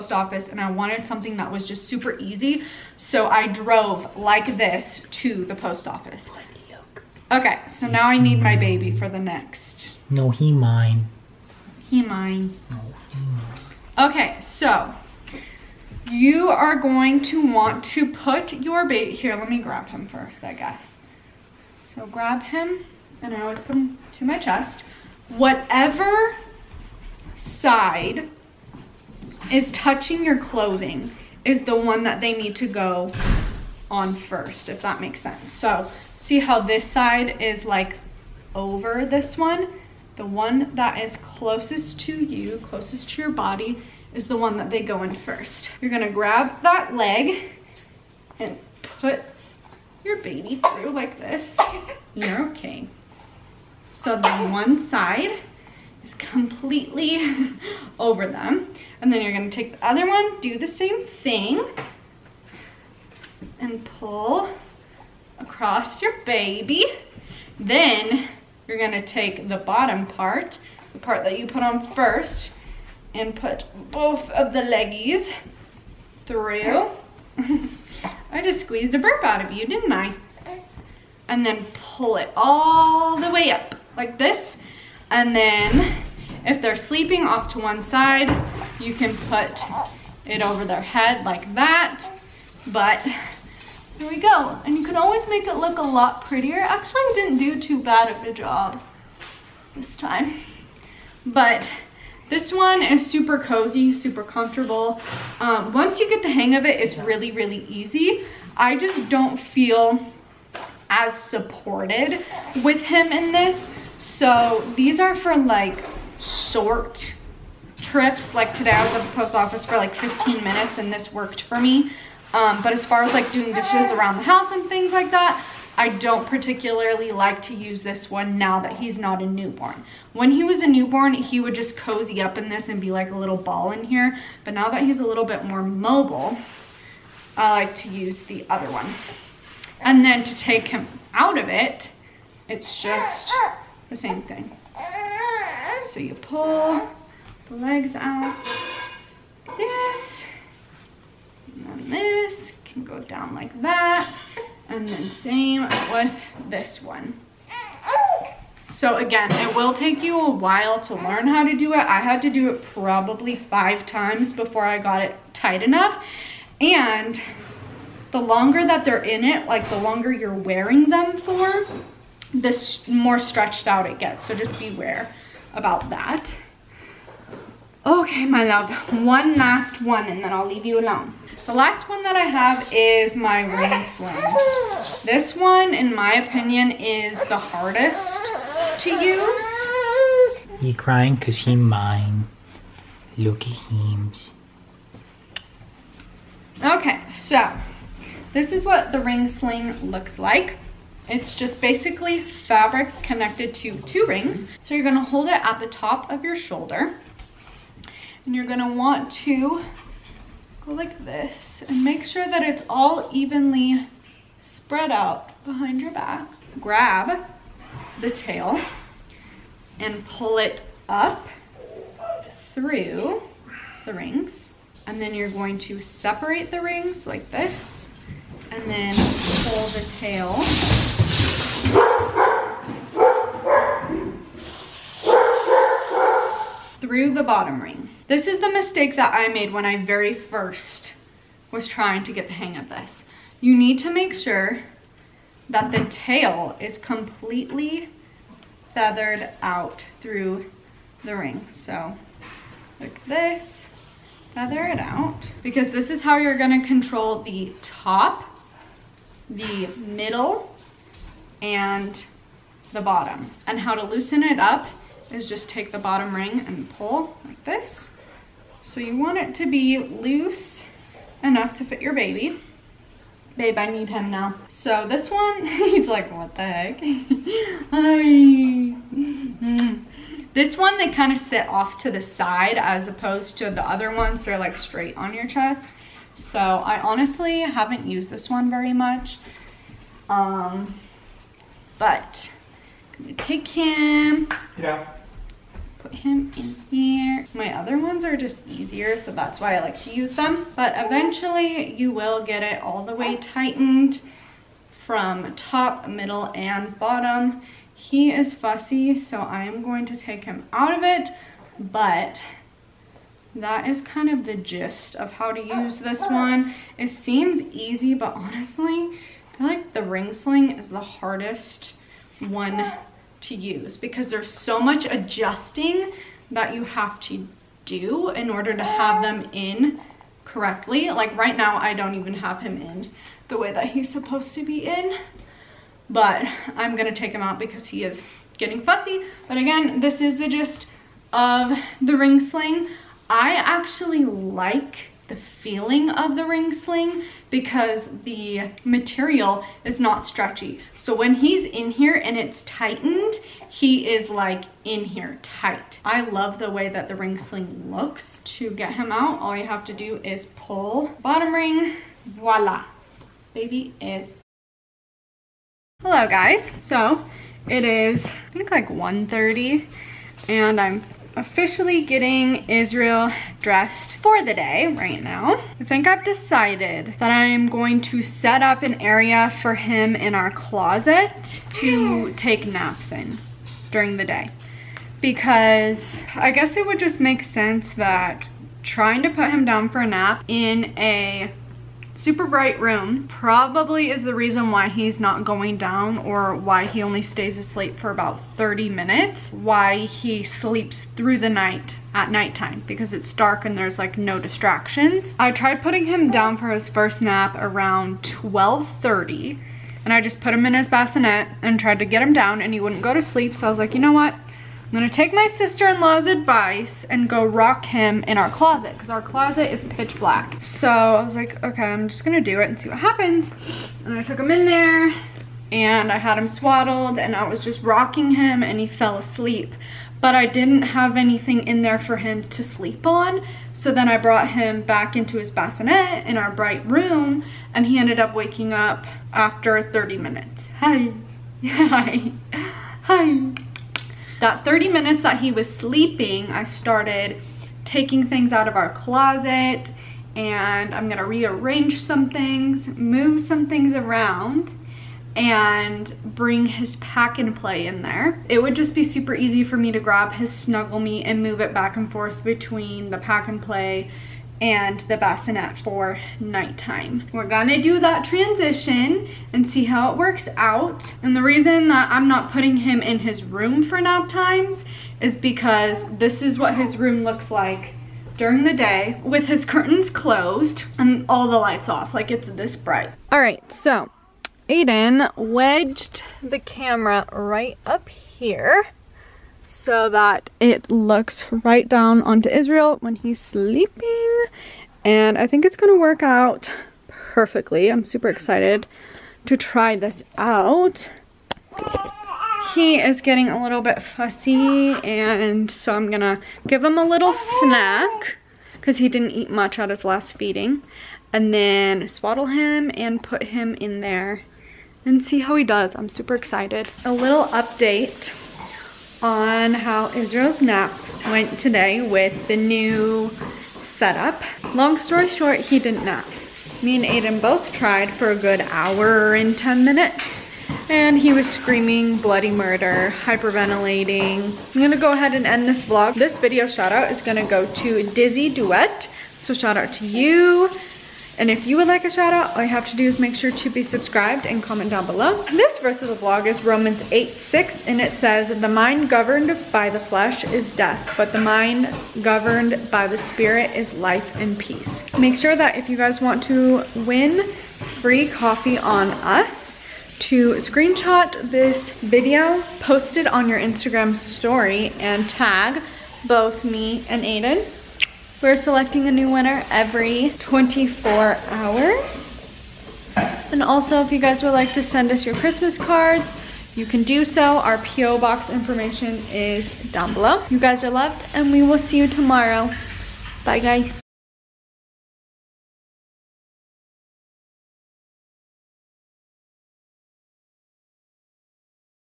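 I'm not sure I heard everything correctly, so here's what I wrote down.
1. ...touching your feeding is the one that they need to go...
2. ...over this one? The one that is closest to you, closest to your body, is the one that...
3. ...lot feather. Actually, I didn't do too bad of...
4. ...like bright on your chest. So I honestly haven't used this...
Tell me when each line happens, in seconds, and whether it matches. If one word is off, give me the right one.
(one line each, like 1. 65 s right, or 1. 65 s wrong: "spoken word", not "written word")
1. 29 s wrong: "clothing", not "feeding"
2. 38 s right
3. 95 s wrong: "prettier", not "feather"
4. 284 s wrong: "straight", not "bright".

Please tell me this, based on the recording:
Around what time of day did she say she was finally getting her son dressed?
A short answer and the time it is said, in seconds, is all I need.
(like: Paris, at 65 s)
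1:30, at 368 s.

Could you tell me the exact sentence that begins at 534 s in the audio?
I'm gonna go ahead and end this vlog.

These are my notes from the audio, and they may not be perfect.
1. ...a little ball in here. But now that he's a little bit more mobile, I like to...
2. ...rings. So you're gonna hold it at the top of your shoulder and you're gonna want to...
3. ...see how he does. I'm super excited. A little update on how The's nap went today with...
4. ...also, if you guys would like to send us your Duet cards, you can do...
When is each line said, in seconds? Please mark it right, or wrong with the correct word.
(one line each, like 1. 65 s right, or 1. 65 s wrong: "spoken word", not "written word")
1. 133 s right
2. 204 s right
3. 515 s wrong: "Israel", not "The"
4. 573 s wrong: "Christmas", not "Duet".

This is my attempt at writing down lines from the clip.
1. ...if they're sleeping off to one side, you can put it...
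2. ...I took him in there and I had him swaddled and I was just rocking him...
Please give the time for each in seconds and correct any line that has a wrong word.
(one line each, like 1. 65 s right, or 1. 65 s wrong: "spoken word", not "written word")
1. 86 s right
2. 423 s right.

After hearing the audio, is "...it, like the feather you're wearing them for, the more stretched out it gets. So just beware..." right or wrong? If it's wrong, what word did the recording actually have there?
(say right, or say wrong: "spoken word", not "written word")
wrong: "longer", not "feather".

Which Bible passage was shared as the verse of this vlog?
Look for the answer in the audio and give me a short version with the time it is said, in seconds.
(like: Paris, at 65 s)
Romans 8:6, at 546 s.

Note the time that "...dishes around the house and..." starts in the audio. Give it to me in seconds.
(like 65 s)
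123 s.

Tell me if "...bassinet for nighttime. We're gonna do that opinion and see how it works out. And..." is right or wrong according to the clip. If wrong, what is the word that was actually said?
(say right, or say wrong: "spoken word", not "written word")
wrong: "transition", not "opinion".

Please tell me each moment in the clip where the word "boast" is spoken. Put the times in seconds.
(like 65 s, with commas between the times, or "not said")
not said.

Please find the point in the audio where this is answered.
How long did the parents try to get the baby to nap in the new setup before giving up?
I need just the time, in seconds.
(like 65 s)
528 s.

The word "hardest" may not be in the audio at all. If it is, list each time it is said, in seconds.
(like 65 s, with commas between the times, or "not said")
187 s, 320 s.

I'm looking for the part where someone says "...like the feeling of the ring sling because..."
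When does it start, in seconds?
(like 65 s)
344 s.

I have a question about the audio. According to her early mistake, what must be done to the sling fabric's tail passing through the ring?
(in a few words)
feathered out.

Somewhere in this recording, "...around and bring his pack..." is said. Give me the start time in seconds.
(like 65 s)
453 s.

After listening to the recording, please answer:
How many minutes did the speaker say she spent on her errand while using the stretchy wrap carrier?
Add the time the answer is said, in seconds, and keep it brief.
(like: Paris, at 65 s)
15, at 119 s.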